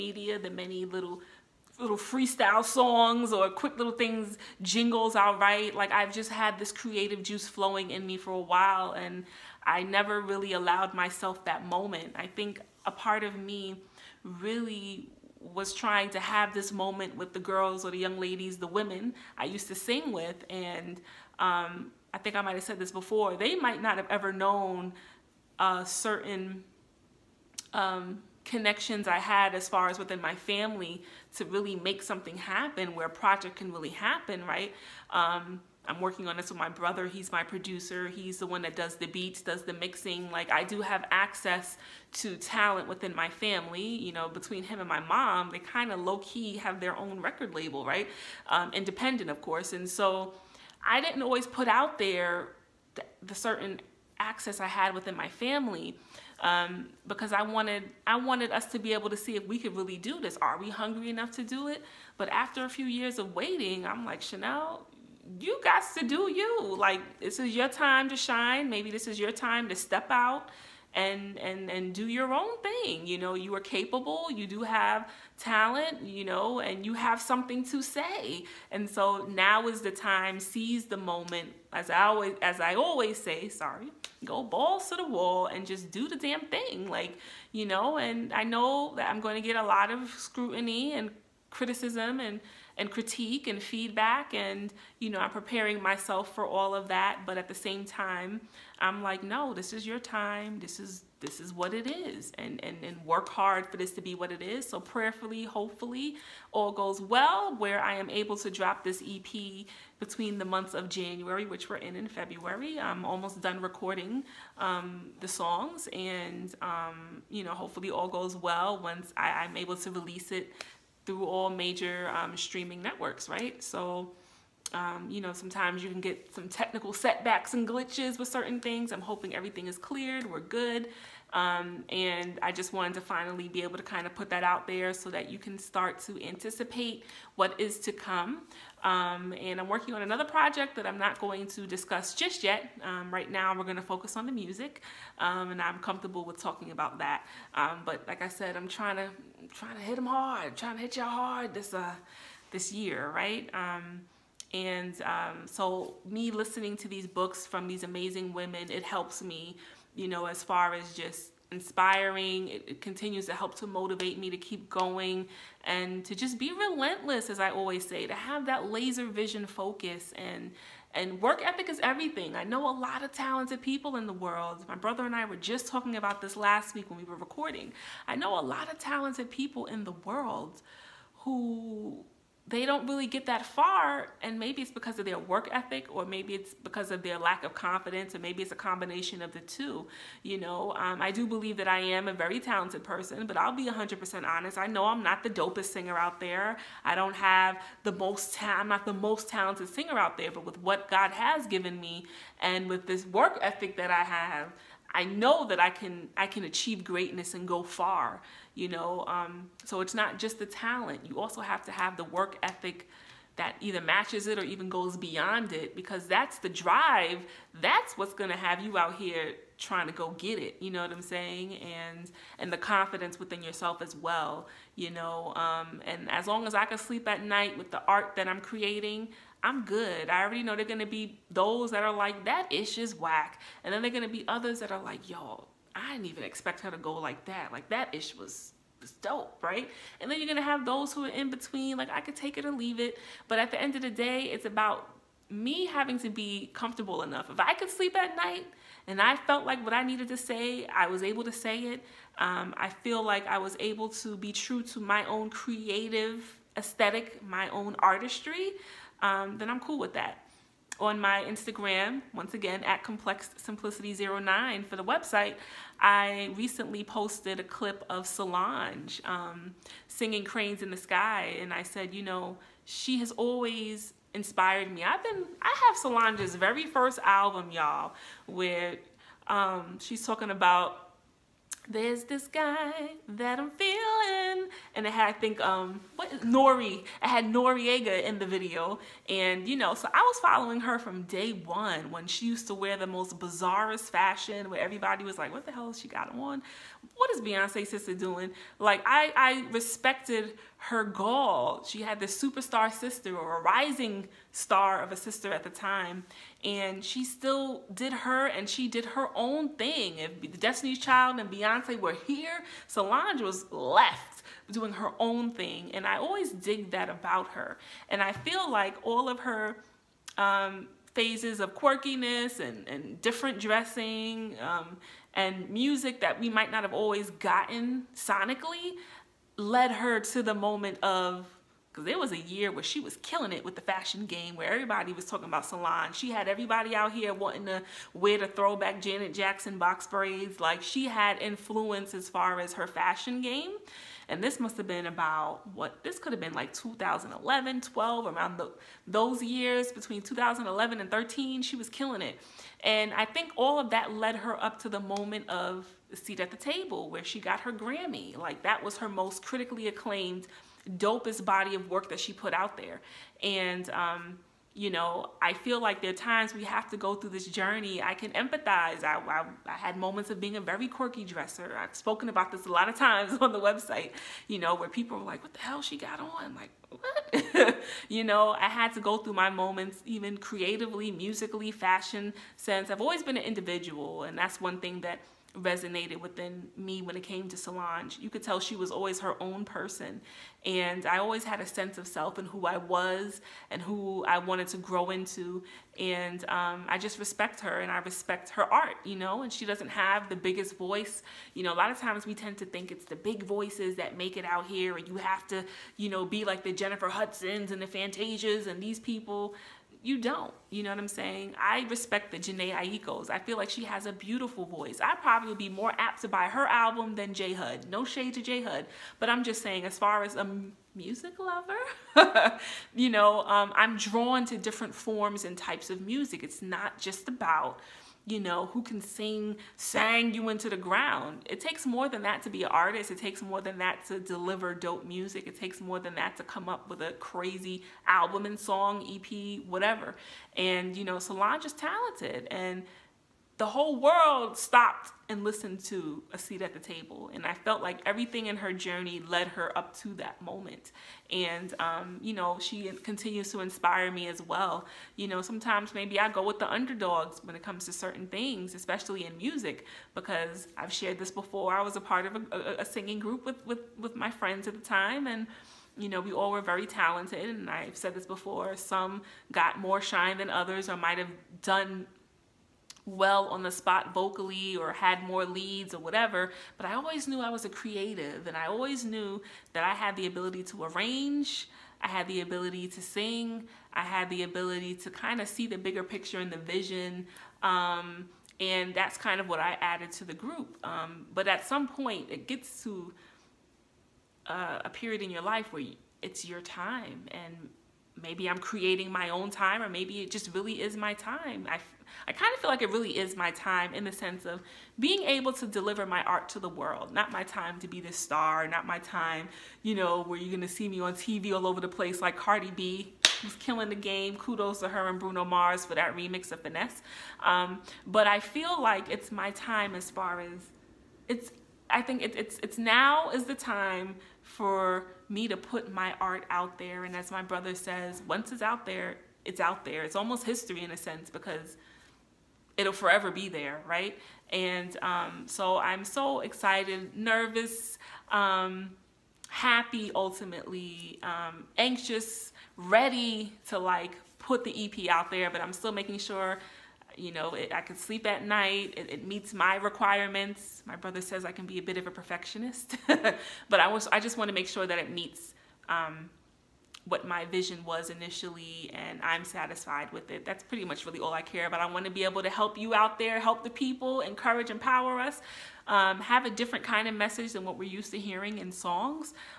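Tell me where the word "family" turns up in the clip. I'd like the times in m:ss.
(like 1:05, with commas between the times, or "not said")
0:30, 0:43, 0:55.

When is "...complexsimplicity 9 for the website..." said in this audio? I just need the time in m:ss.
4:22.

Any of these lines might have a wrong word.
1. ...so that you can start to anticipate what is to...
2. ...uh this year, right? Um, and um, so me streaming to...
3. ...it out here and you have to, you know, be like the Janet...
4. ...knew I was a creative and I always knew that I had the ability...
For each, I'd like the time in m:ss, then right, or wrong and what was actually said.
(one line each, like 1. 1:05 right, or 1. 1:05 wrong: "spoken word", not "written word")
1. 2:14 right
2. 2:31 wrong: "listening", not "streaming"
3. 6:44 wrong: "Jennifer", not "Janet"
4. 7:57 right.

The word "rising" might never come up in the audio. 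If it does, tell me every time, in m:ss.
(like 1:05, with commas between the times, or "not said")
5:03.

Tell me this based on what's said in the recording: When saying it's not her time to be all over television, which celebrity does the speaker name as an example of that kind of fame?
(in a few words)
Cardi B.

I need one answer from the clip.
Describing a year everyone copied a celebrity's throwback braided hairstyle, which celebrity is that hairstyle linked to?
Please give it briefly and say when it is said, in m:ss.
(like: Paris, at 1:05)
Janet Jackson, at 5:38.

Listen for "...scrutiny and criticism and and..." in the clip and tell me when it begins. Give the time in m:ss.
1:30.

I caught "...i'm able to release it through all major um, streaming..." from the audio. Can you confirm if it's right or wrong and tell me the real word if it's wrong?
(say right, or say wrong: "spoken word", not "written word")
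right.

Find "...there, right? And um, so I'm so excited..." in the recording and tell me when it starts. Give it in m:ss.
8:53.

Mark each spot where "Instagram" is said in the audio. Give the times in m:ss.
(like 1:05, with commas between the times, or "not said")
4:21.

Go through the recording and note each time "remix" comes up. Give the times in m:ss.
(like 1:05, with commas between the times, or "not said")
8:35.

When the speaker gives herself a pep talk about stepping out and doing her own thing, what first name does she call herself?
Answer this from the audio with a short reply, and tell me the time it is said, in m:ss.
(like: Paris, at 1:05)
Chanel, at 1:04.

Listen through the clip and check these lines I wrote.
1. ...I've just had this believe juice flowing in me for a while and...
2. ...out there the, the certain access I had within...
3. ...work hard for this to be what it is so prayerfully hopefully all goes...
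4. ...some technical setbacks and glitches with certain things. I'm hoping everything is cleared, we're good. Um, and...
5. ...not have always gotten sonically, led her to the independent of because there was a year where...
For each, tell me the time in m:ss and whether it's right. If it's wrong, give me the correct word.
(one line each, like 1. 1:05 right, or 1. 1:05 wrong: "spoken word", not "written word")
1. 0:05 wrong: "creative", not "believe"
2. 0:51 right
3. 1:43 right
4. 2:06 right
5. 5:26 wrong: "moment", not "independent".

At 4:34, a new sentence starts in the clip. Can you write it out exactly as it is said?
I've been, I have Solange's very first album, y'all, where um, she's talking about there's this guy that I'm feeling.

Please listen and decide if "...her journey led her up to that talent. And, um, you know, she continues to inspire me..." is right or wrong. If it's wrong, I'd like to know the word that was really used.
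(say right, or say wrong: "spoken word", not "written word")
wrong: "moment", not "talent".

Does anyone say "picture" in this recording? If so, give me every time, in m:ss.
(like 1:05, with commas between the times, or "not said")
8:05.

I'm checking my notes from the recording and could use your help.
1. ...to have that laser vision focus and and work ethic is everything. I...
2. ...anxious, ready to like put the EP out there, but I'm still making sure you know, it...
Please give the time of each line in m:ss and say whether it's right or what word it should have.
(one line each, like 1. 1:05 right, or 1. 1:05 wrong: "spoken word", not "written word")
1. 2:48 right
2. 9:01 right.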